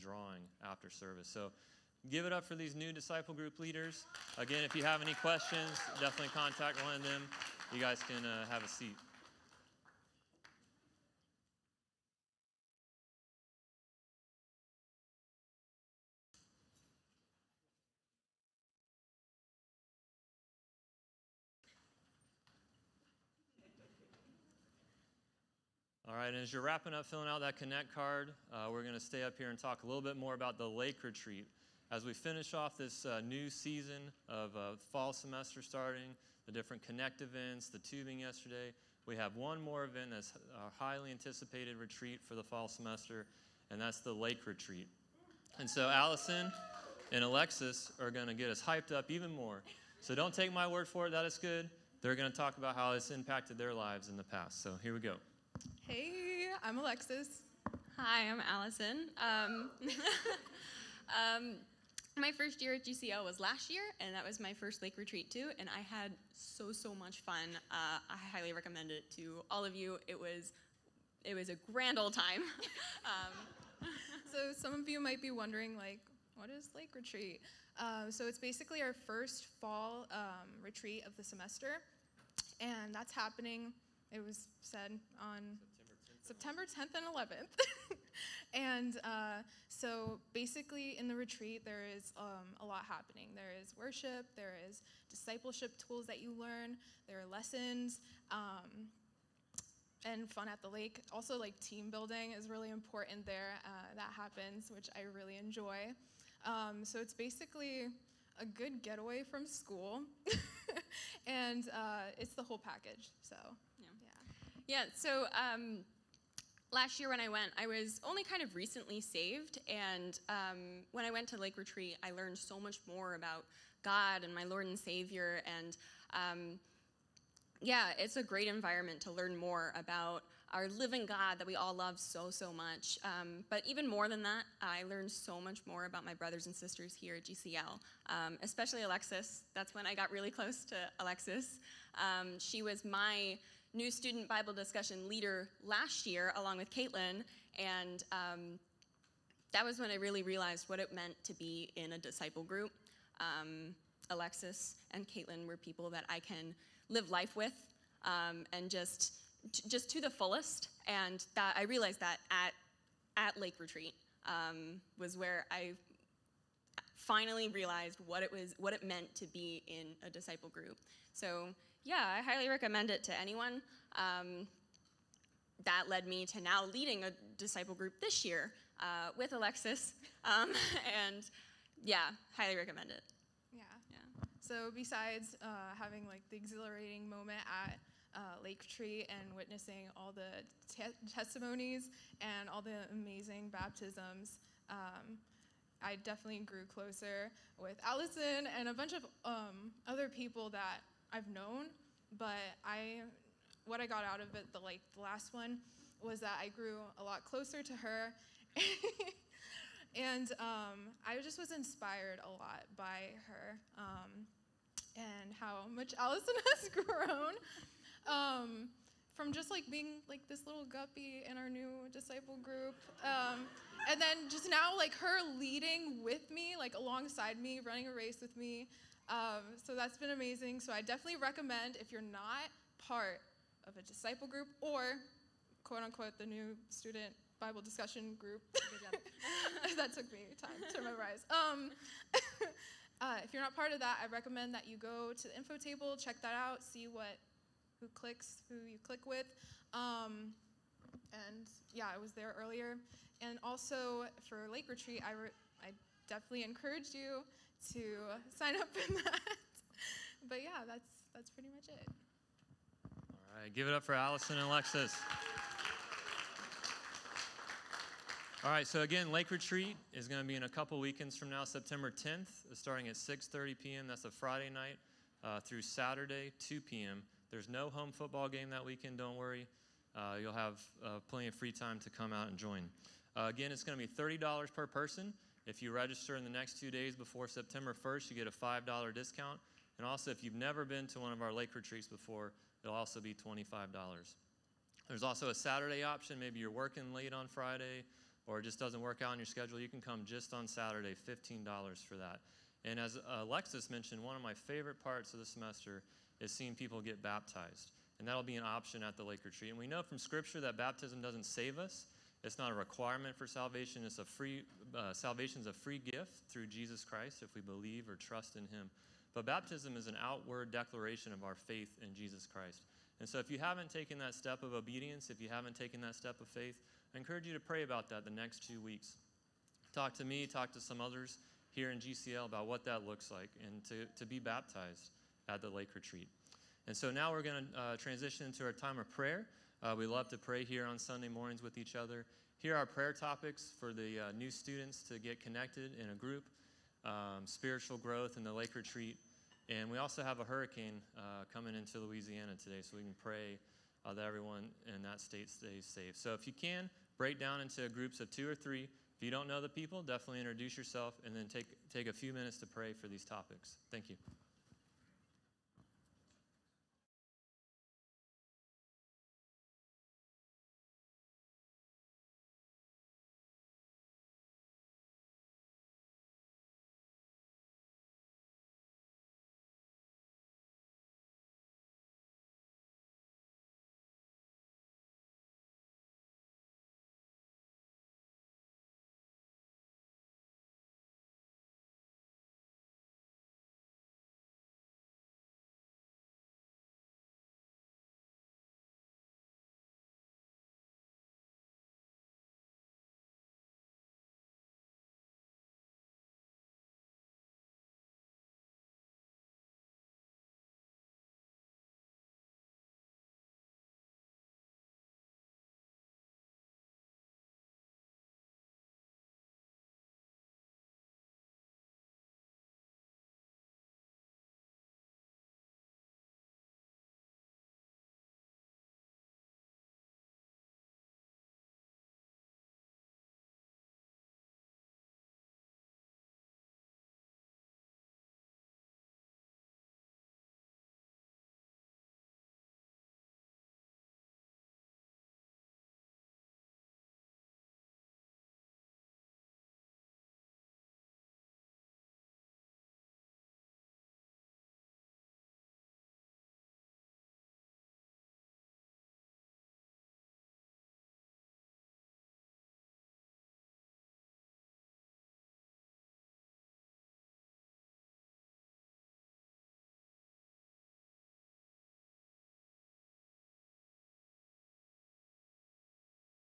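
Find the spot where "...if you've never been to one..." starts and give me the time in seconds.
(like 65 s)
290 s.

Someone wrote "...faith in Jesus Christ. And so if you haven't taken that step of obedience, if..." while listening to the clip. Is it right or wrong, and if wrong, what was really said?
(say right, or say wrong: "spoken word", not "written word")
right.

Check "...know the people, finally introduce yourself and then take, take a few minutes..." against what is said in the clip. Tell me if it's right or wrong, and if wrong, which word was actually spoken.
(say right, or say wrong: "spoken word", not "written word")
wrong: "definitely", not "finally".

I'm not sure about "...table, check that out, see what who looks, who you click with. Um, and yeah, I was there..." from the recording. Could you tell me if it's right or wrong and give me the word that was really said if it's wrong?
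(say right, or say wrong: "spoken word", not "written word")
wrong: "clicks", not "looks".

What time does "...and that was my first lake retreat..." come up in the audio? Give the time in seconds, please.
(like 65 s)
64 s.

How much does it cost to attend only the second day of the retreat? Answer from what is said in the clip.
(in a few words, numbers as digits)
$15.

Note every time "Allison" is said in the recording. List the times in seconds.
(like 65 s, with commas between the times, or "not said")
45 s, 58 s, 197 s, 215 s, 263 s.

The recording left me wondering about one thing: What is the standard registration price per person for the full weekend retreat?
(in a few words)
$30.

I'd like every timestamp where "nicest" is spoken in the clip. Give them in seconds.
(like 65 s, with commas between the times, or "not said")
not said.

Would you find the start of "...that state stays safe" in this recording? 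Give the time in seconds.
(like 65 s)
354 s.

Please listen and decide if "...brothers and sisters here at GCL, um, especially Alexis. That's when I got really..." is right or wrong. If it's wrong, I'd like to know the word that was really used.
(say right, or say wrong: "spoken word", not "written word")
right.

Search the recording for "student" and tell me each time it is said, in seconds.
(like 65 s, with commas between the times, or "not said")
143 s, 236 s, 344 s.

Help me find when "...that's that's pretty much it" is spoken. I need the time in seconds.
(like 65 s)
260 s.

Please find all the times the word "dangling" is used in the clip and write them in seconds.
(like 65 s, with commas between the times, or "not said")
not said.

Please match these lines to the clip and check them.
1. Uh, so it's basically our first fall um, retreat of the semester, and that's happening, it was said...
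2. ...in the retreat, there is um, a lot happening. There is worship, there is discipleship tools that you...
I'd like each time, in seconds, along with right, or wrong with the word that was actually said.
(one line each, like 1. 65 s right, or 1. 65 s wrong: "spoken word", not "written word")
1. 77 s right
2. 90 s right.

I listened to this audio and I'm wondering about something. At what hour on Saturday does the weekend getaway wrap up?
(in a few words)
2 p.m.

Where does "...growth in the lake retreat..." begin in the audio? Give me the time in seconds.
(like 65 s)
347 s.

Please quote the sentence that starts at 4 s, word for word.
Again, if you have any questions, definitely contact one of them.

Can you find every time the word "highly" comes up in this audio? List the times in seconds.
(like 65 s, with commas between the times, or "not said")
40 s, 68 s, 172 s, 182 s.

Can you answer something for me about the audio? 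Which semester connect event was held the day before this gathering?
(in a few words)
Tubing.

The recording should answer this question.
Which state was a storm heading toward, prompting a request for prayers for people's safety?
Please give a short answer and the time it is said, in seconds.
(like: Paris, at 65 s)
Louisiana, at 351 s.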